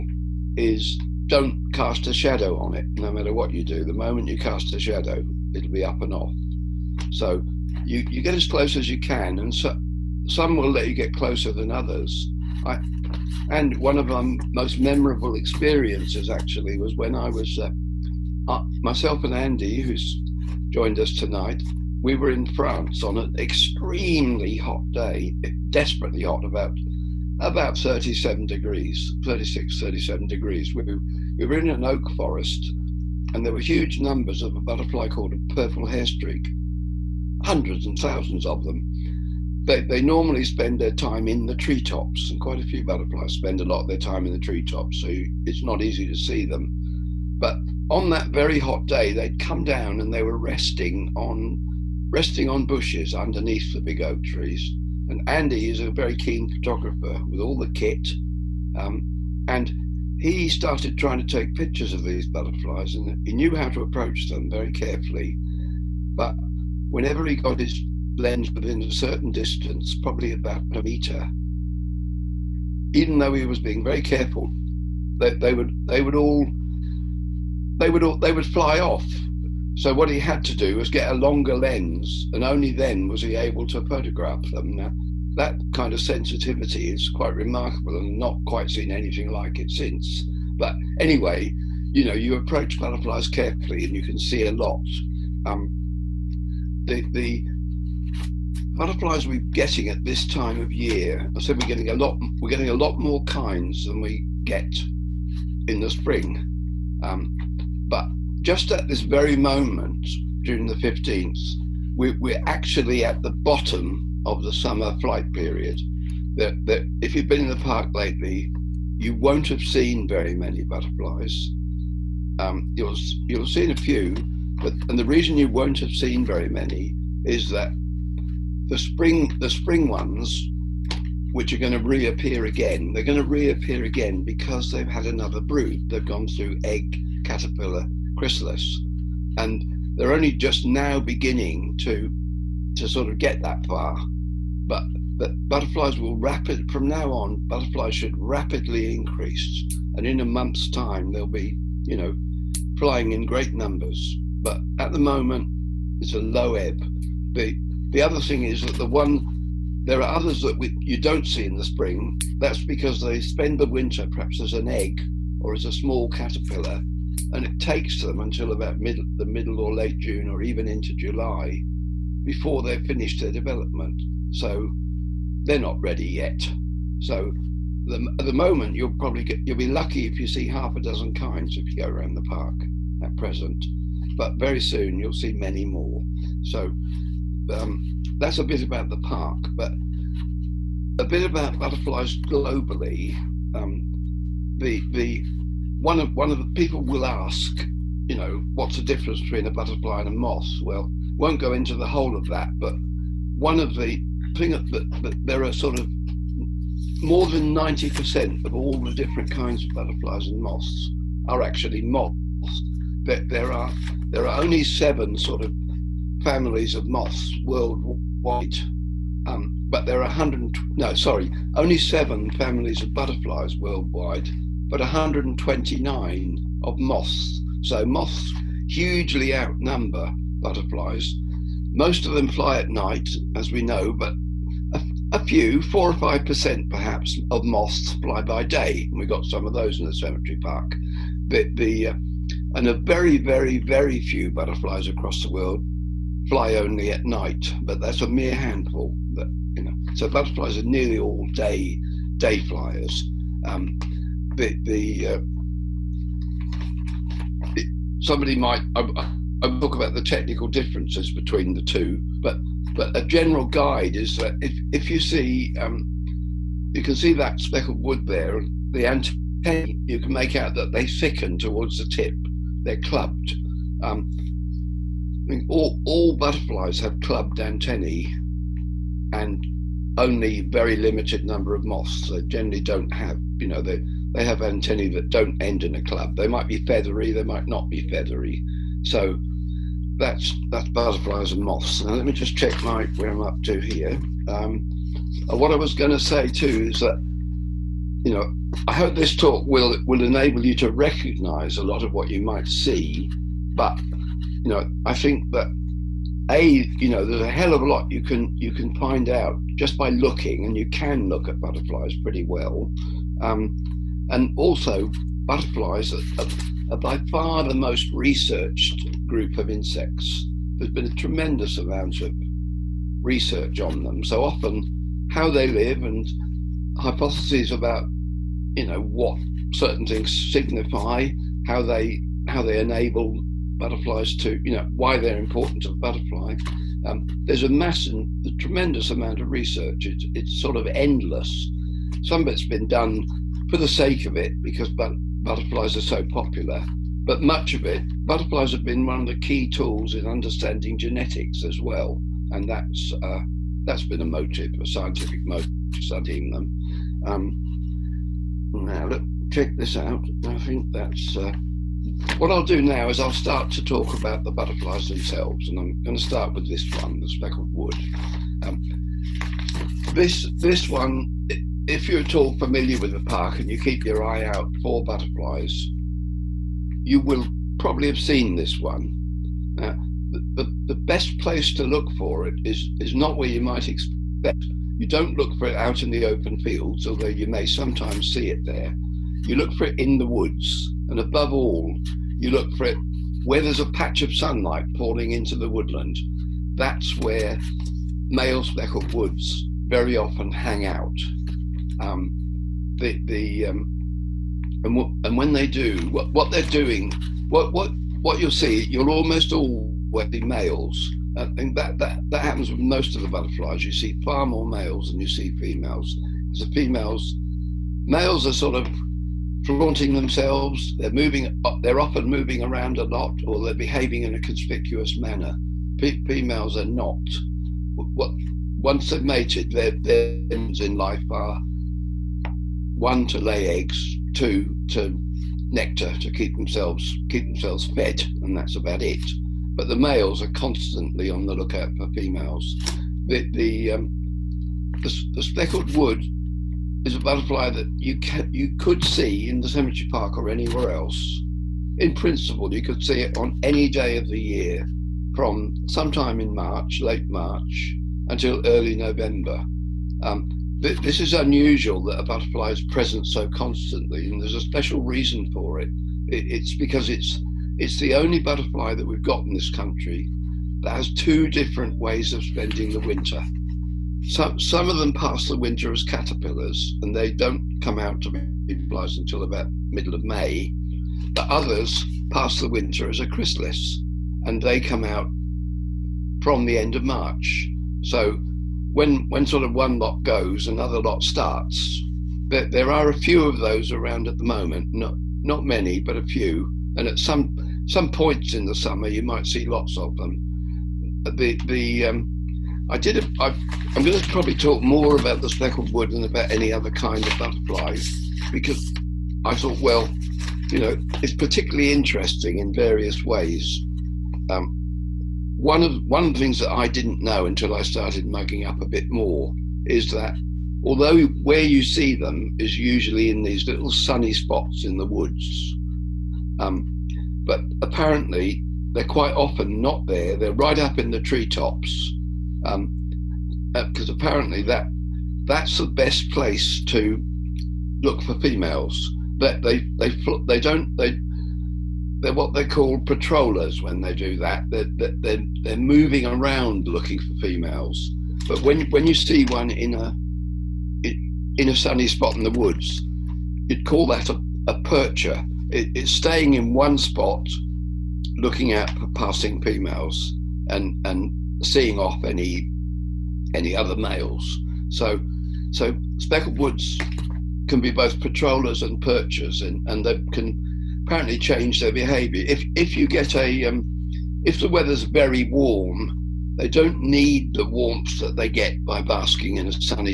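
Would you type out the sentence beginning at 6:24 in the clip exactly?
You don't look for it out in the open fields, although you may sometimes see it there.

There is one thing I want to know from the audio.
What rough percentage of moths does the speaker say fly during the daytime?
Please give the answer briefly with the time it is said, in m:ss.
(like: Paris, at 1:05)
4 or 5 percent, at 3:55.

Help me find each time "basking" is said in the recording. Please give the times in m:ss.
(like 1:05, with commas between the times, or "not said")
9:38.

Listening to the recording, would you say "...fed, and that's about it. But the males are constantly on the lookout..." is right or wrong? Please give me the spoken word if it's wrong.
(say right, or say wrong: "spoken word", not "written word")
right.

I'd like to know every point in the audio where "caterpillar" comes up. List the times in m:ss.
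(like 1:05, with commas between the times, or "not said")
2:17, 2:46, 7:55.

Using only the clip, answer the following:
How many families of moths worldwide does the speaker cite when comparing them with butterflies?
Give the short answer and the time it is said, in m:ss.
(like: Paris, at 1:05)
129, at 3:44.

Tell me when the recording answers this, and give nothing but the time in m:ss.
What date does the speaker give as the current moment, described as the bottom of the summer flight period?
1:50.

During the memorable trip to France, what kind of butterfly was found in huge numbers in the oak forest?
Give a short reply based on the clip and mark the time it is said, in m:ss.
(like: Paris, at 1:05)
purple hairstreak, at 0:35.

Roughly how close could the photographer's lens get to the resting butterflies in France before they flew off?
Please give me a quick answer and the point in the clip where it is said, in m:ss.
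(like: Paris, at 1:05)
about 1 meter, at 1:10.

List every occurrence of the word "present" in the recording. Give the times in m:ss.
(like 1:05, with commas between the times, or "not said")
3:03, 7:42.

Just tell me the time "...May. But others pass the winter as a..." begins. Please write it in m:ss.
8:00.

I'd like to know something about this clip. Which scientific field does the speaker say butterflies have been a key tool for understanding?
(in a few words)
genetics.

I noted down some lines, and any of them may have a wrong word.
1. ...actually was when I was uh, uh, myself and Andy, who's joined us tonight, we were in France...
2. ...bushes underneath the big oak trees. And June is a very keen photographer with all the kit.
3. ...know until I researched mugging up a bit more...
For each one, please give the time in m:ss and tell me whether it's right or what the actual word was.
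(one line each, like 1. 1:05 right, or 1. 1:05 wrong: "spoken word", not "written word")
1. 0:16 right
2. 0:52 wrong: "Andy", not "June"
3. 8:37 wrong: "started", not "researched".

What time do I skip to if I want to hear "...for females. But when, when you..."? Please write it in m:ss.
9:06.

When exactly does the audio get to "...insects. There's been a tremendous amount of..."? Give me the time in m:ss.
5:19.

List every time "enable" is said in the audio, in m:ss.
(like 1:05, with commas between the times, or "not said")
5:00, 5:32.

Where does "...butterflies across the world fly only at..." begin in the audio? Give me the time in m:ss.
4:04.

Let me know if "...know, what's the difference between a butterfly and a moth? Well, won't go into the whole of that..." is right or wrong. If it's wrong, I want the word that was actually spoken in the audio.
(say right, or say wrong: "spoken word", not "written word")
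right.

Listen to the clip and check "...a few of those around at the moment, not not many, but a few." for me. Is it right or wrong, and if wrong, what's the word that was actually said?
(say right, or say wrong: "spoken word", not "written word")
right.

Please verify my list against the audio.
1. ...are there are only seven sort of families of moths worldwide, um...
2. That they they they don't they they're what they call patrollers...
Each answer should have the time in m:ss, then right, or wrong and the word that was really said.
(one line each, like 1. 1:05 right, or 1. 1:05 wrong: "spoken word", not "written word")
1. 3:33 right
2. 8:59 right.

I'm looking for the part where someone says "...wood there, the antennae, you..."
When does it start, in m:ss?
4:27.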